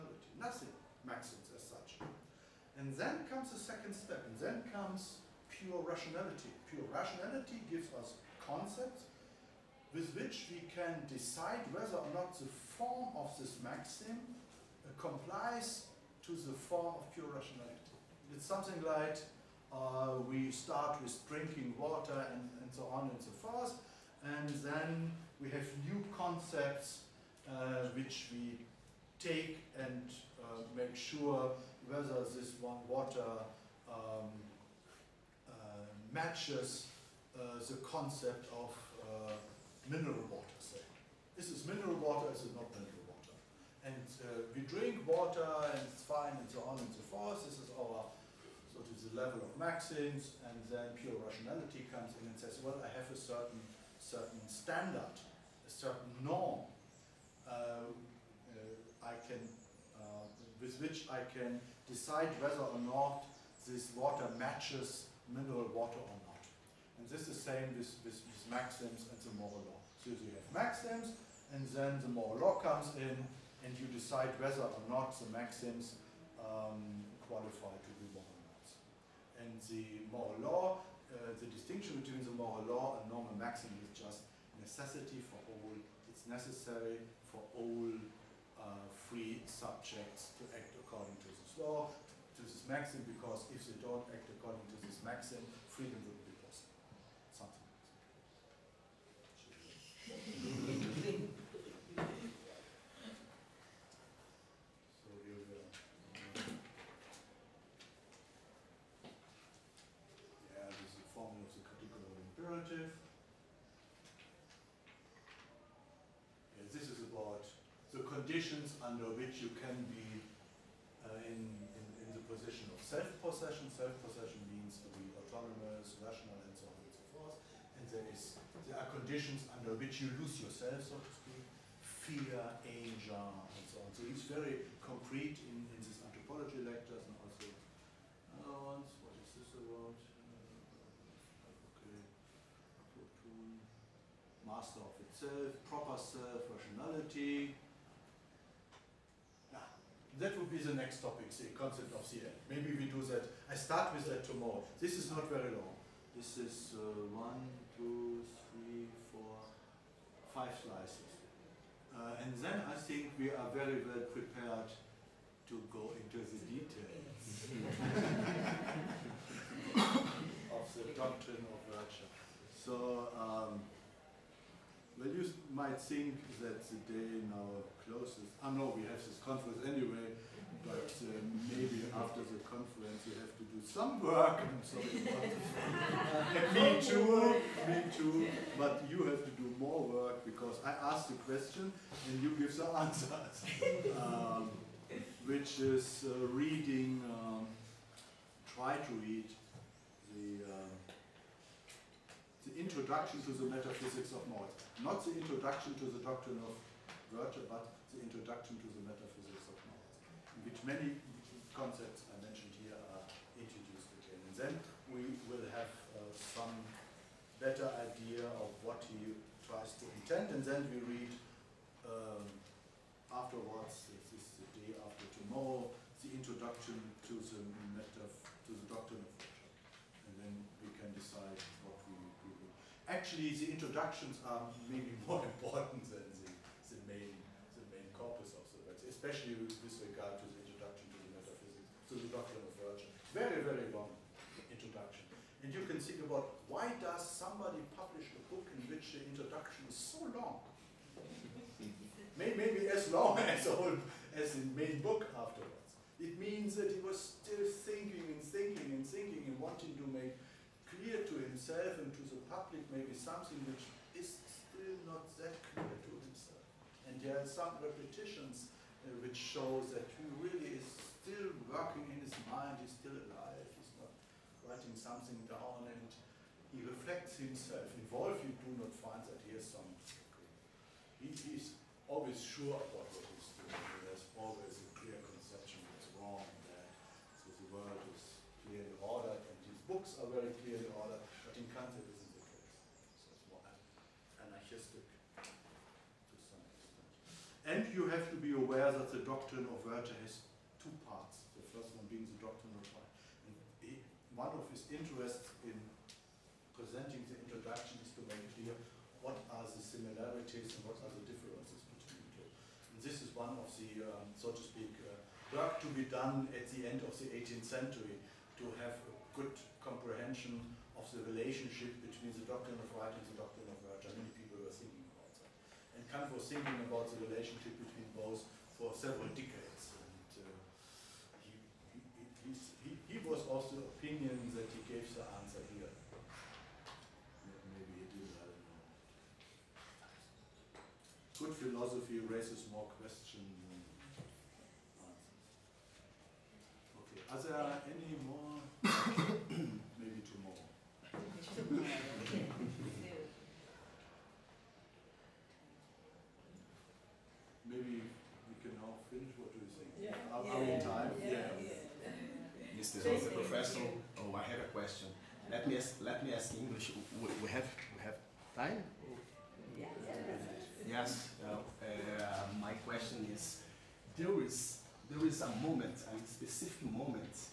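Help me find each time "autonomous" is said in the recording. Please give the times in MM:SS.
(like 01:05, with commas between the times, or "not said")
02:05.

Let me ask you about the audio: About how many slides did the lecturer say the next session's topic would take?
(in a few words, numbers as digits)
5.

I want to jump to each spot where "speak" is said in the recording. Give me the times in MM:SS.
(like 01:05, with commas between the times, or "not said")
02:11, 05:14.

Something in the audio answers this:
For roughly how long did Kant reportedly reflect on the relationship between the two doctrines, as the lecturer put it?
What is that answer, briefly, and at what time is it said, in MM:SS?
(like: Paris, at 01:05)
Several decades, at 05:28.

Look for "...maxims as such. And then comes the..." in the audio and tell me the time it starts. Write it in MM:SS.
00:01.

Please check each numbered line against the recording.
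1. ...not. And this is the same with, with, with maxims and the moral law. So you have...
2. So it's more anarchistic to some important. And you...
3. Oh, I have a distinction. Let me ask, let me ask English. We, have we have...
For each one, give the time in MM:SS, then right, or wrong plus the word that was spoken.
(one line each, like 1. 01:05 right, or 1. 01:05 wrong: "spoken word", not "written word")
1. 01:06 right
2. 04:53 wrong: "extent", not "important"
3. 06:03 wrong: "question", not "distinction".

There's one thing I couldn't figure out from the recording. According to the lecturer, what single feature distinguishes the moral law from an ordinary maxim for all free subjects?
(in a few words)
Necessity.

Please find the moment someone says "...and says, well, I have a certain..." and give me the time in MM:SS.
00:52.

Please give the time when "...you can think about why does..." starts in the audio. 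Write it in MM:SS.
04:05.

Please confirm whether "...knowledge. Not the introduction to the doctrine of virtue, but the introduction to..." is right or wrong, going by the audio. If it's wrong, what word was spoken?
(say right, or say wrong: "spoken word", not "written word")
right.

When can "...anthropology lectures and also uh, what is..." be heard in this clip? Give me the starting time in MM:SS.
02:16.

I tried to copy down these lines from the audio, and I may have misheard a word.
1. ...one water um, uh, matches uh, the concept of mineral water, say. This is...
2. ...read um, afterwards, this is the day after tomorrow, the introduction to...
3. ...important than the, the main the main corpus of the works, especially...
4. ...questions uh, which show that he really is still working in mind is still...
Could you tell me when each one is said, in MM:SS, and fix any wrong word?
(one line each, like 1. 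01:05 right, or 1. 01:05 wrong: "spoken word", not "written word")
1. 00:32 right
2. 03:40 right
3. 03:55 right
4. 04:27 wrong: "repetitions", not "questions".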